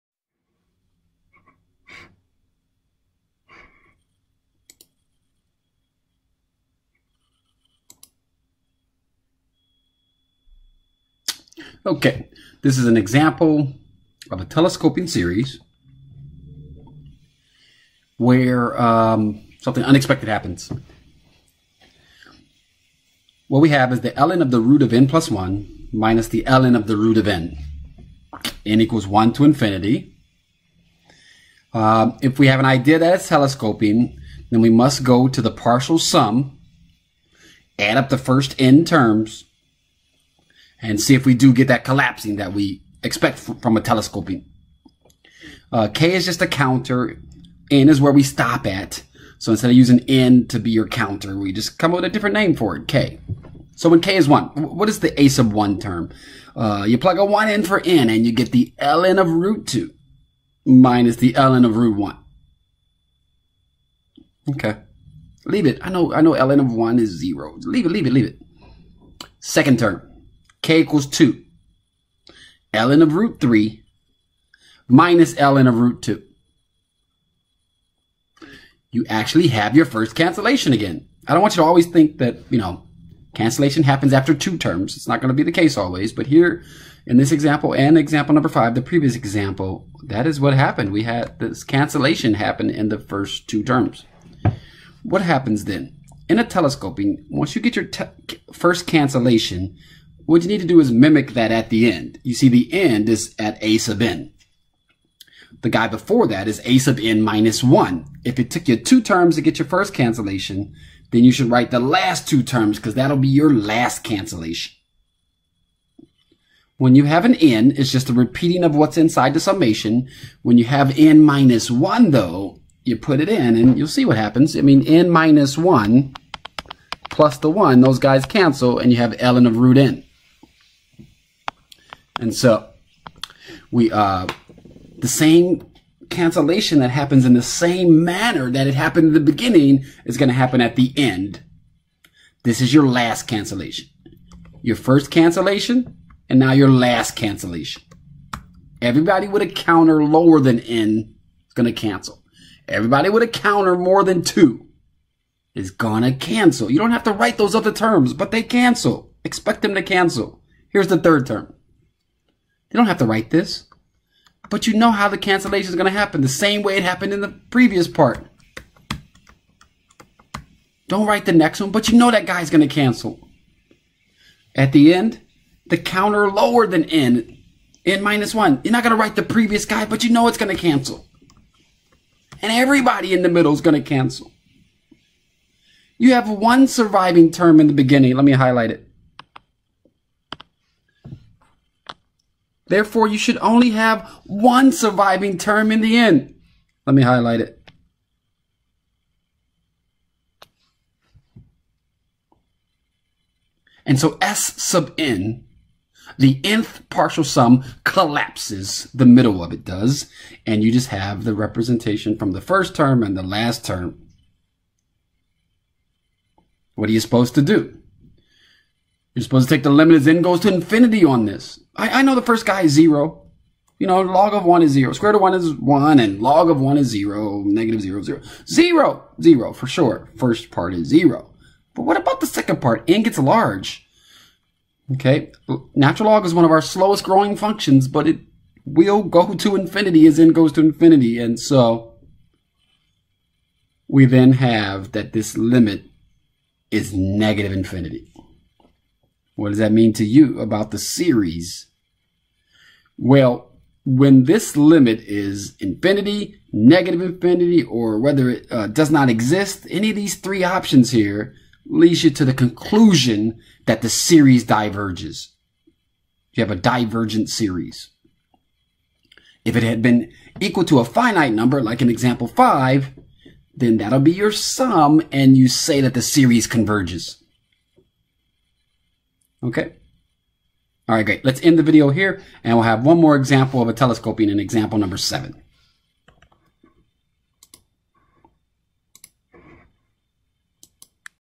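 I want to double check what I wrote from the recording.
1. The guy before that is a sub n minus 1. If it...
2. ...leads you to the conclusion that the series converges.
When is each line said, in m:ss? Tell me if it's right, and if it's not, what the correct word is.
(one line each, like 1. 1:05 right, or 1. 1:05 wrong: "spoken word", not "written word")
1. 1:45 right
2. 4:21 wrong: "diverges", not "converges".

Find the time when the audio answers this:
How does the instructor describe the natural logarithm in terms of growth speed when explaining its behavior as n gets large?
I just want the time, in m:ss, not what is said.
3:56.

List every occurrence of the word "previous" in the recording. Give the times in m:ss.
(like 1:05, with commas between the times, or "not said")
1:28, 2:47, 2:59.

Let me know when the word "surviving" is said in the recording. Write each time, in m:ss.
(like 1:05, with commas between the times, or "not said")
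3:06, 3:14.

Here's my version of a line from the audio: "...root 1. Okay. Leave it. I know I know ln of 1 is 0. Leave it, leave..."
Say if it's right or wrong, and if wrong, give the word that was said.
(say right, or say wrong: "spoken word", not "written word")
right.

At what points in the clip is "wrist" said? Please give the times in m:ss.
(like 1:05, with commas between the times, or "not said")
not said.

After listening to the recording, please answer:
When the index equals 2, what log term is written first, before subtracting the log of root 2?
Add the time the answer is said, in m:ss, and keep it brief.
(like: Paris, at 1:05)
ln of root 3, at 1:12.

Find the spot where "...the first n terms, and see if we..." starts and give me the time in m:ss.
0:38.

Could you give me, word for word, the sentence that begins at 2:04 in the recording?
I mean, n minus 1 plus the 1, those guys cancel, and you have ln of root n.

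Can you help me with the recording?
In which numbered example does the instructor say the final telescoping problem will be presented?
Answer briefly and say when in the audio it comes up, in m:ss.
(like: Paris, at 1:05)
example number 7, at 4:44.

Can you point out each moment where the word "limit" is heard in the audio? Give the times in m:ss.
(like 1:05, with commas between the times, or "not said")
3:39, 4:05, 4:14.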